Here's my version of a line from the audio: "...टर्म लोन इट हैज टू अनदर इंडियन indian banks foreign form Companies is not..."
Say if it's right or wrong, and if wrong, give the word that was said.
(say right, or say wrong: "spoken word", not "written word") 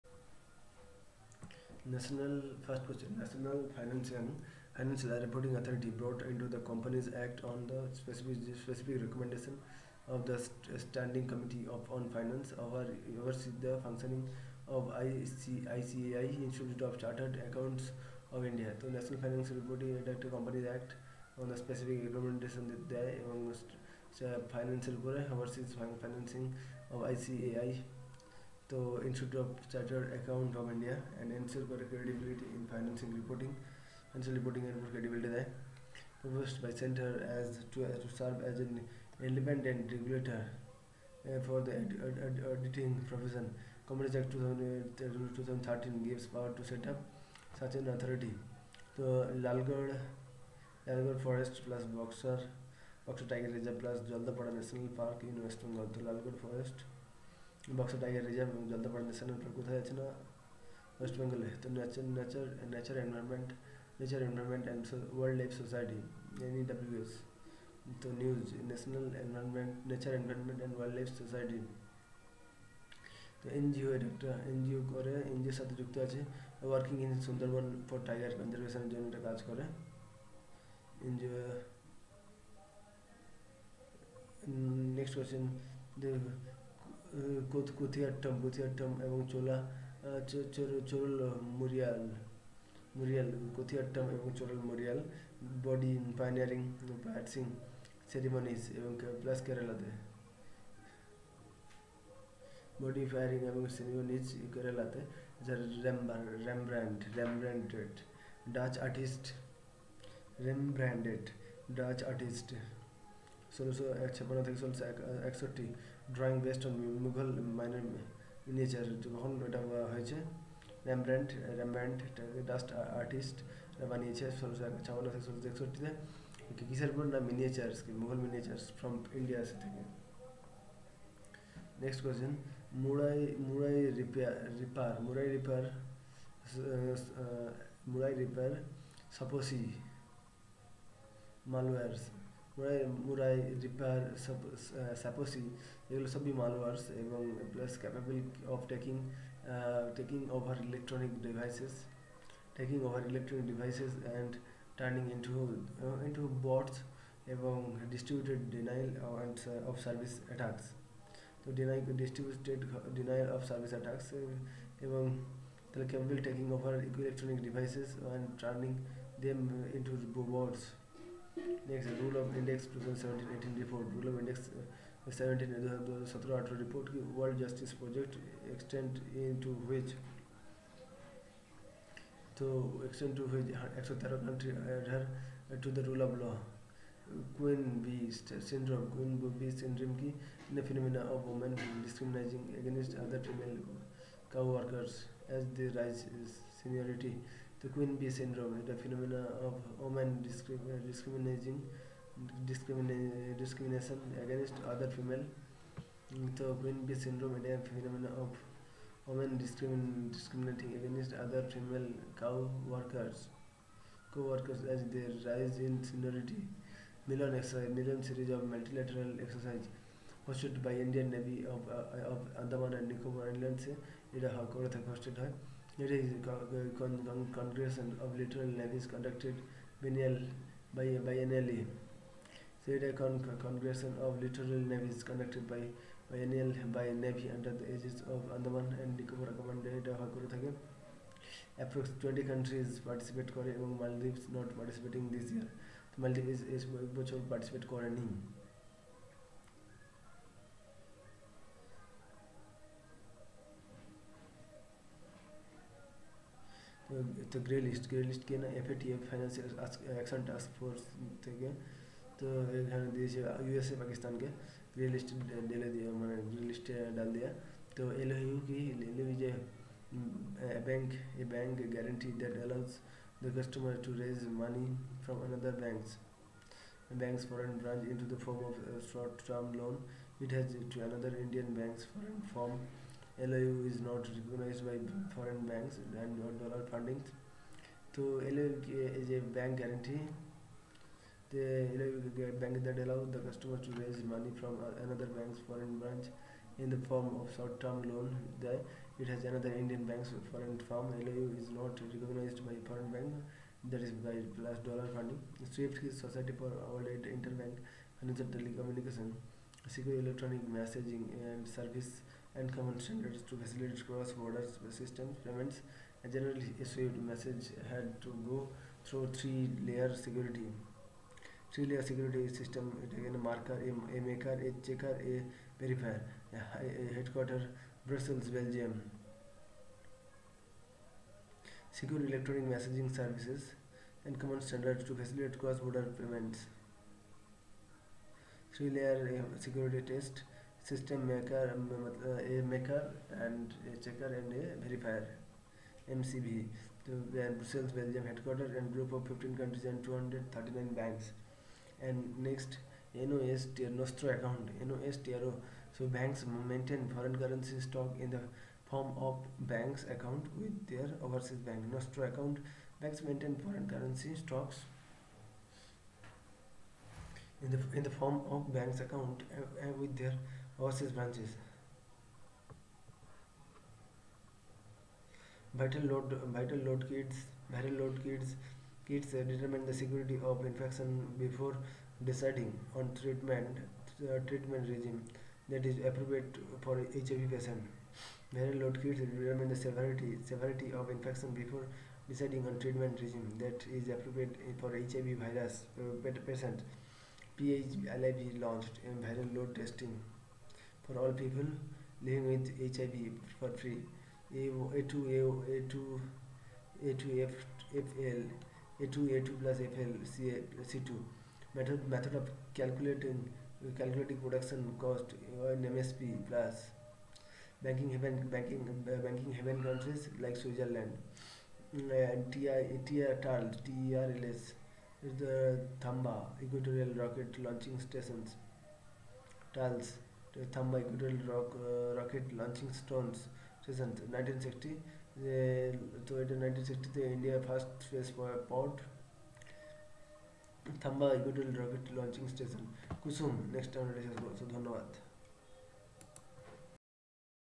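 wrong: "LOU", not "Companies".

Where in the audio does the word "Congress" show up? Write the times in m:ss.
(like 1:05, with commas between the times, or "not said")
3:47, 3:53.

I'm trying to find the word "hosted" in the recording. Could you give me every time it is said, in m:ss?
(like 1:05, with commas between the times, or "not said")
3:40.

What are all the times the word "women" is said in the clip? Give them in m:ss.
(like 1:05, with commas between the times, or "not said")
3:19, 3:29.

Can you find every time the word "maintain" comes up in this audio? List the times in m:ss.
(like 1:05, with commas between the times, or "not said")
5:56, 6:03.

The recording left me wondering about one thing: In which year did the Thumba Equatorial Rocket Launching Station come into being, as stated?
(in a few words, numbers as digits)
1960.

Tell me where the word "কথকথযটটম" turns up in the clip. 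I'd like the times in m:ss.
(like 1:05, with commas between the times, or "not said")
1:27.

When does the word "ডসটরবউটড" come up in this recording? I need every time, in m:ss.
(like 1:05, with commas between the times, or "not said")
2:37, 2:42.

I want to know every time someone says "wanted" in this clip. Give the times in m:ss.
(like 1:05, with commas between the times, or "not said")
not said.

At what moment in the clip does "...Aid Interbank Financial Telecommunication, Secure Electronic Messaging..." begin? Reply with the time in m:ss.
5:07.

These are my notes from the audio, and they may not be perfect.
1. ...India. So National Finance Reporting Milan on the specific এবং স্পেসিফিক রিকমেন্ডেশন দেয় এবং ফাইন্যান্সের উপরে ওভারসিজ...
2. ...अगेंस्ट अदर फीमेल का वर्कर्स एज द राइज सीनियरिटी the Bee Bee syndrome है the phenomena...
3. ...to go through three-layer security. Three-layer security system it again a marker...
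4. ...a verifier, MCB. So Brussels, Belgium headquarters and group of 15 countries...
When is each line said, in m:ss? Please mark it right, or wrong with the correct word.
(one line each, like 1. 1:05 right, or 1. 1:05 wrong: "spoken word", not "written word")
1. 0:18 wrong: "Act", not "Milan"
2. 3:12 wrong: "Queen", not "Bee"
3. 5:18 right
4. 5:44 right.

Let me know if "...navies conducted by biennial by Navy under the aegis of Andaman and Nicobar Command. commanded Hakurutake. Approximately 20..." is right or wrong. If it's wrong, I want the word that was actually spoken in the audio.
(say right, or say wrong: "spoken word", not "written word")
right.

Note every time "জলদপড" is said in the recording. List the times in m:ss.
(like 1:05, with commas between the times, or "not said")
0:58.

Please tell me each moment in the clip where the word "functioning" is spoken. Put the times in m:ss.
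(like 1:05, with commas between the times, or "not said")
0:13.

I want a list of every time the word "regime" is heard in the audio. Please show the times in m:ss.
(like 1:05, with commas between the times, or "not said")
6:24, 6:33.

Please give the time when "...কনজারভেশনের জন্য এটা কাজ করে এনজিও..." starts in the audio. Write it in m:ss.
1:18.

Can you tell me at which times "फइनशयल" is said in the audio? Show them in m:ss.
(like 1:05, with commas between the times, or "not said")
0:33, 4:19.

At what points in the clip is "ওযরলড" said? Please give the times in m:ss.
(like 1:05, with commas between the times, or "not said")
1:05, 1:10.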